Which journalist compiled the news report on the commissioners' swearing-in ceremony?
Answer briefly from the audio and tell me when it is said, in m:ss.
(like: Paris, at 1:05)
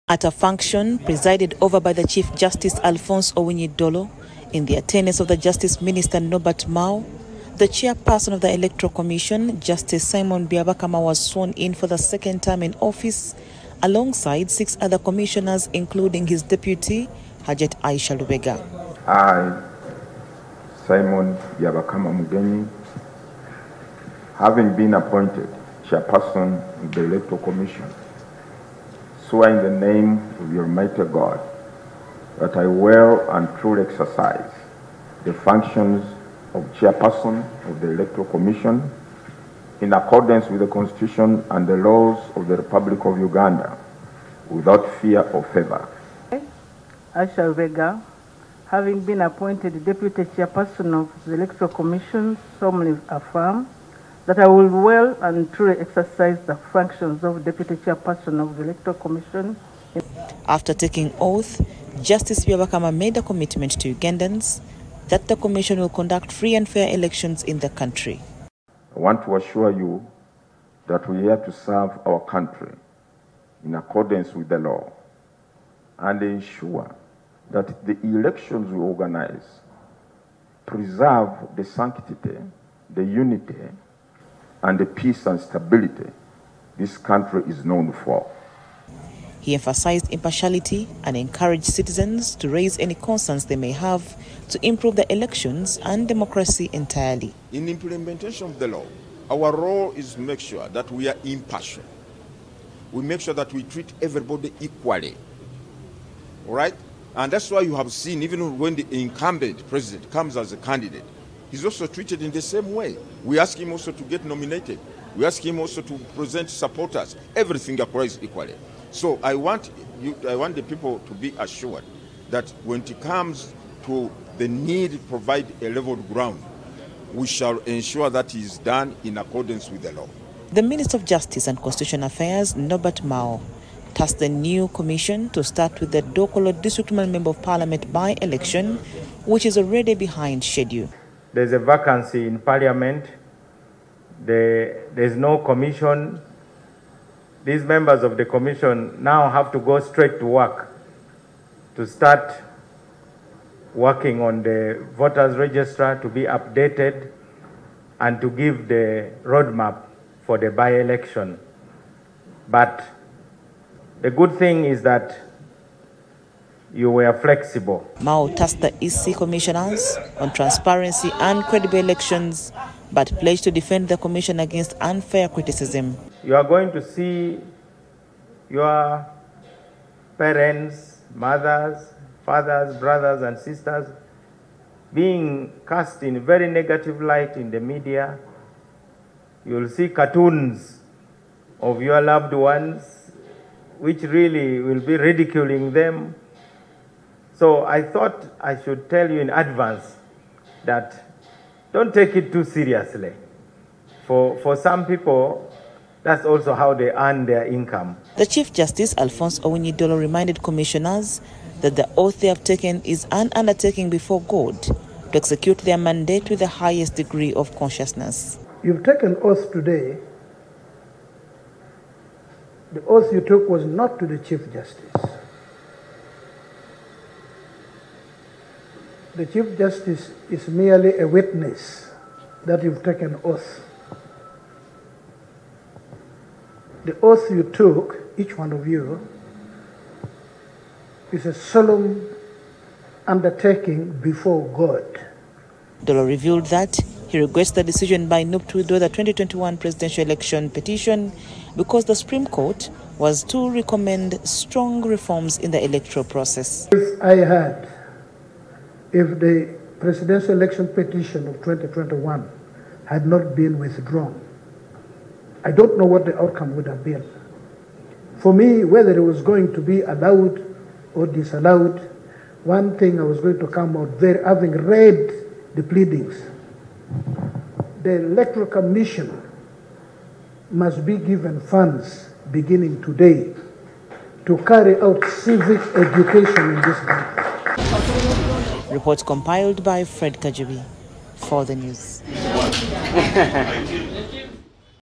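Fred Kajabi, at 4:49.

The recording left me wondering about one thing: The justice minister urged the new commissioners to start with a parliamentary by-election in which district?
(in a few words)
Dokolo.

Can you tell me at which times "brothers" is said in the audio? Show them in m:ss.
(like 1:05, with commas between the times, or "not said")
3:02.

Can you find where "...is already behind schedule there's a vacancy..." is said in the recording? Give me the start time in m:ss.
2:19.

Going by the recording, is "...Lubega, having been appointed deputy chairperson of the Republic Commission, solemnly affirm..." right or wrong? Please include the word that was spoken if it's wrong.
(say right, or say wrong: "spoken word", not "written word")
wrong: "Electoral", not "Republic".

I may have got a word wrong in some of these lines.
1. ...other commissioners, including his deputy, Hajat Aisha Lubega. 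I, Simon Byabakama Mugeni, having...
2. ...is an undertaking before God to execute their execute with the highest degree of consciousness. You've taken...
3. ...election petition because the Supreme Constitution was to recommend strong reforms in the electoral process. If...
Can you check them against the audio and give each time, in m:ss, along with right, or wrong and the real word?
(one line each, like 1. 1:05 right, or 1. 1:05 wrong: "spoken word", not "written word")
1. 0:14 right
2. 3:32 wrong: "mandate", not "execute"
3. 4:10 wrong: "Court", not "Constitution".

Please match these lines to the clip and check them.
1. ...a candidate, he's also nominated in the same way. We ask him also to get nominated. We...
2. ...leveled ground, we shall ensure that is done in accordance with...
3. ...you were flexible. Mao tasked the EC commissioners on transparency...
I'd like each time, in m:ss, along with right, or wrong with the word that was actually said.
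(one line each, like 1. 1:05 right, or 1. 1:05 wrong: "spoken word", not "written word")
1. 1:50 wrong: "treated", not "nominated"
2. 2:05 right
3. 2:46 right.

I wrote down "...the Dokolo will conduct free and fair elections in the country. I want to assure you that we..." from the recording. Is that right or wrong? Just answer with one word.
wrong.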